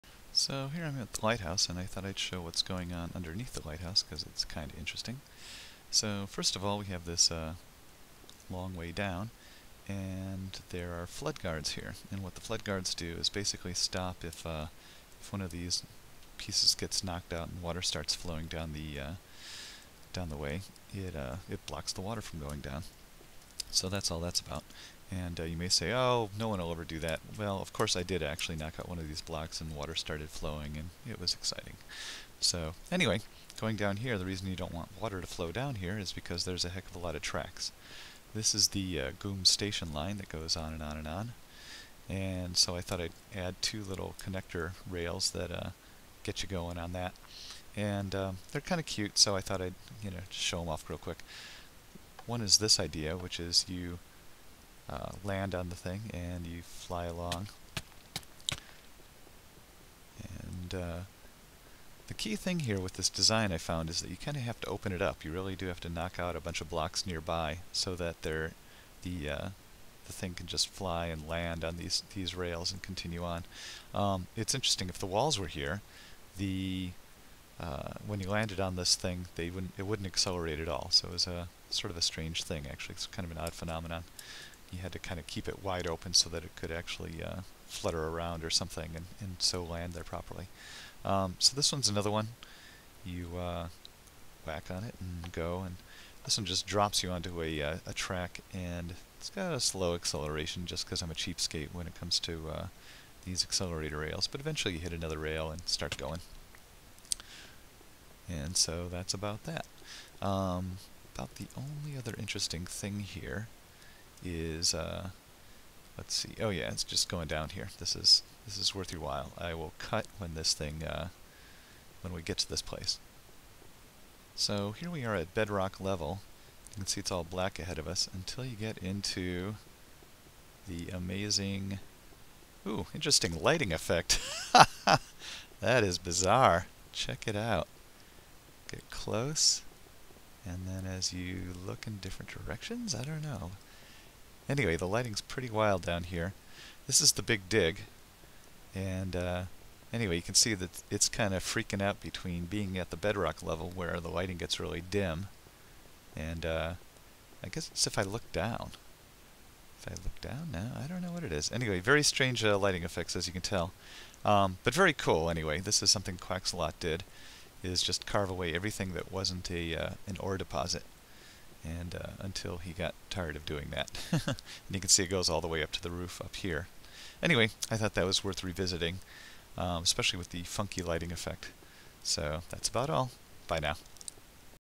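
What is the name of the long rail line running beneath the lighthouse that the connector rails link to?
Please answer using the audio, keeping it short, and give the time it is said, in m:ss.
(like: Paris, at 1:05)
Goom station line, at 0:39.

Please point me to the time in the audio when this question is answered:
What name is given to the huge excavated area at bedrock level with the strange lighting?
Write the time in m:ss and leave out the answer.
2:27.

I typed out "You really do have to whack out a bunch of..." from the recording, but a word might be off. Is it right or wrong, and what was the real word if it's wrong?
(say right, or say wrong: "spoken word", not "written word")
wrong: "knock", not "whack".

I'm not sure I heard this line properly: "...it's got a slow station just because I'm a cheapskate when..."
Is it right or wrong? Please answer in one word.
wrong.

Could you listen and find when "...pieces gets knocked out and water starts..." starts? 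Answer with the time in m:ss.
0:16.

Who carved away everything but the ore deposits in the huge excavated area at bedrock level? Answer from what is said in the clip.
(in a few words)
Quaxalot.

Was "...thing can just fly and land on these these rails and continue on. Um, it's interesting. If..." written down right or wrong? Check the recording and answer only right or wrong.
right.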